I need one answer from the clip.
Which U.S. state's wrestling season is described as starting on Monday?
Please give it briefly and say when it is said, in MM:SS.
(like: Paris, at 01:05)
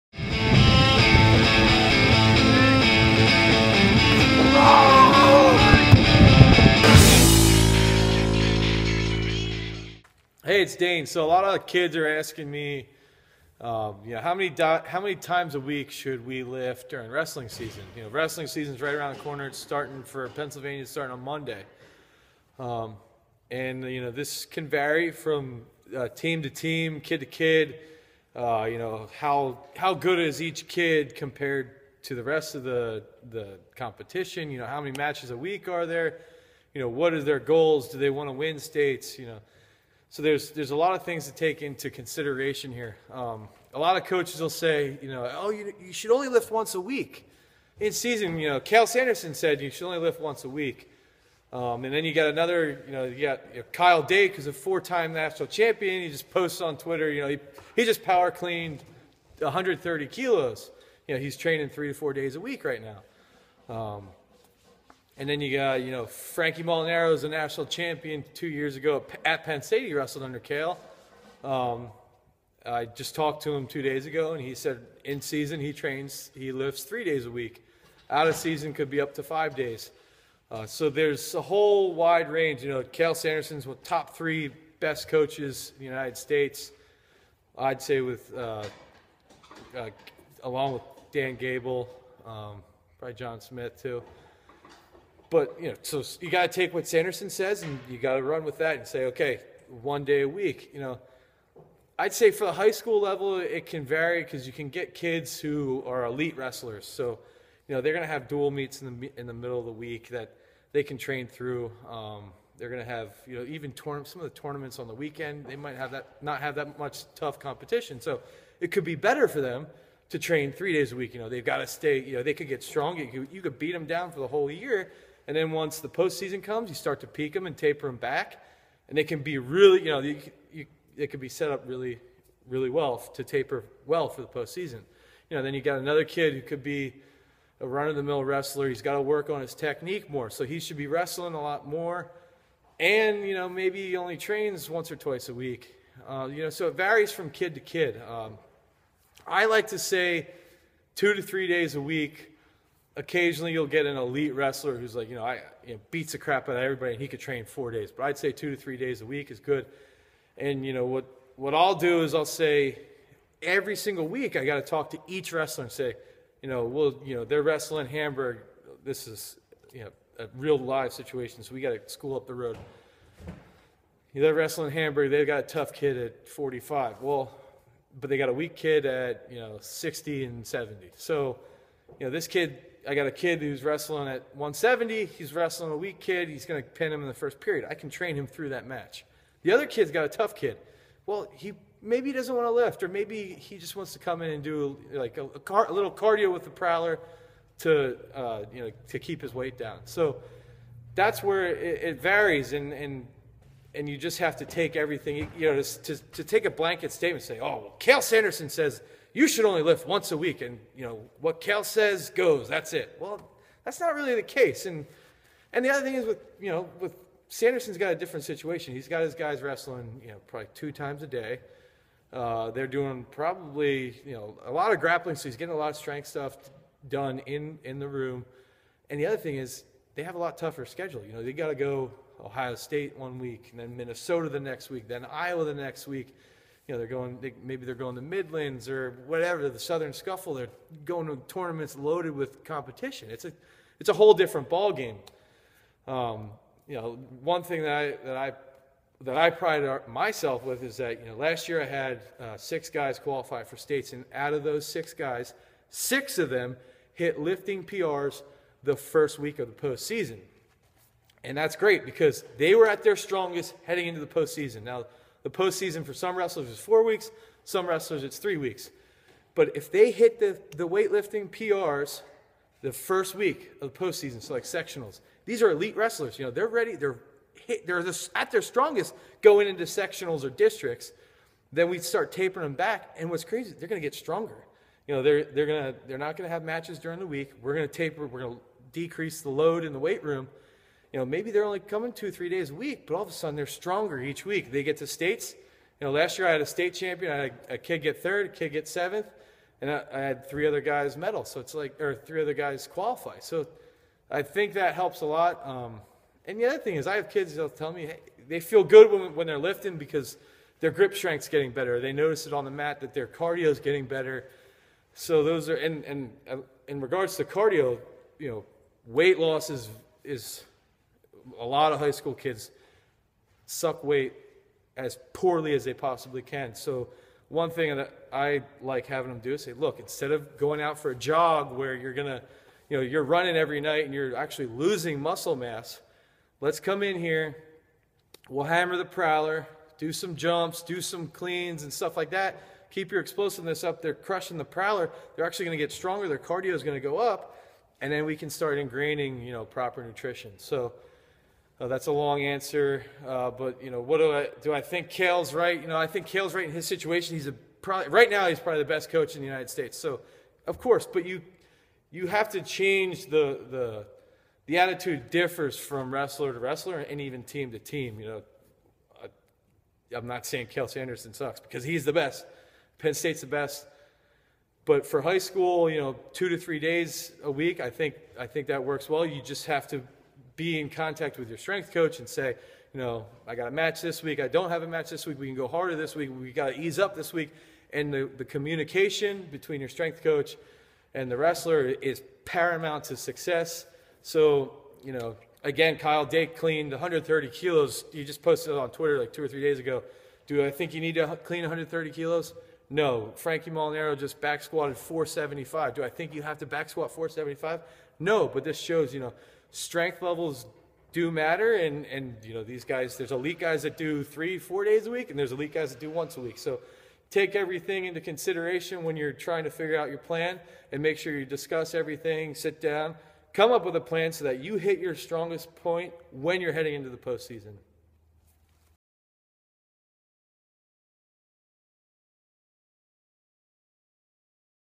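Pennsylvania, at 00:20.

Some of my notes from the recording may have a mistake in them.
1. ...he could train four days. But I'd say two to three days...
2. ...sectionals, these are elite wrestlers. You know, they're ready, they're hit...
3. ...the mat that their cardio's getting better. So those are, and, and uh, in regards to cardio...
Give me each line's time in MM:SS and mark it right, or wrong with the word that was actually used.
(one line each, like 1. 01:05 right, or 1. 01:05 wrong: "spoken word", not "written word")
1. 02:37 right
2. 04:34 right
3. 05:12 right.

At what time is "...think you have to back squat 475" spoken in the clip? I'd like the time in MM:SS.
06:45.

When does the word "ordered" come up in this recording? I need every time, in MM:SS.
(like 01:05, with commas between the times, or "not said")
not said.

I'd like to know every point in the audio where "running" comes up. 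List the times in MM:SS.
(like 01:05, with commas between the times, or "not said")
05:33.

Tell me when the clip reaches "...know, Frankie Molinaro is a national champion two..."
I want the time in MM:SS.
01:05.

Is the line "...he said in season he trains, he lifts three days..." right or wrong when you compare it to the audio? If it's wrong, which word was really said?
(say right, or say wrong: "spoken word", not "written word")
right.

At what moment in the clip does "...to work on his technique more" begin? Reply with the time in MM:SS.
02:18.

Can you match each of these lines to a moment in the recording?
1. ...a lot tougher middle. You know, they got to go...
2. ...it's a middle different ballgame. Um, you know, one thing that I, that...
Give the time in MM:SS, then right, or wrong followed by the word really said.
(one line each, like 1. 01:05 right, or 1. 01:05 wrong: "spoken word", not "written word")
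1. 03:50 wrong: "schedule", not "middle"
2. 04:03 wrong: "whole", not "middle".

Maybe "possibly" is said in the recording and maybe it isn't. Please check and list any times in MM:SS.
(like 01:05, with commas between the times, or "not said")
05:25.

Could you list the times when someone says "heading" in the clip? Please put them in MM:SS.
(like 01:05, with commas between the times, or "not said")
04:23, 07:06.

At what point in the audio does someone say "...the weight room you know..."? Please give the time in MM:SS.
04:49.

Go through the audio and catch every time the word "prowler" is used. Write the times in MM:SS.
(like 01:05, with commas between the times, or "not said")
03:16, 05:38, 05:44.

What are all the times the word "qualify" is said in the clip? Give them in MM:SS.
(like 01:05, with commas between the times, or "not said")
04:12, 05:02.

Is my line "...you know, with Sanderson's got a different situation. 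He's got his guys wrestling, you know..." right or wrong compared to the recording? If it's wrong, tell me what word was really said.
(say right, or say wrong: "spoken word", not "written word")
right.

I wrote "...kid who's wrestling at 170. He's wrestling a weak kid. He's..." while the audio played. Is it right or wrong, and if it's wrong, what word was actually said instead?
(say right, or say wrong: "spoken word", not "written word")
right.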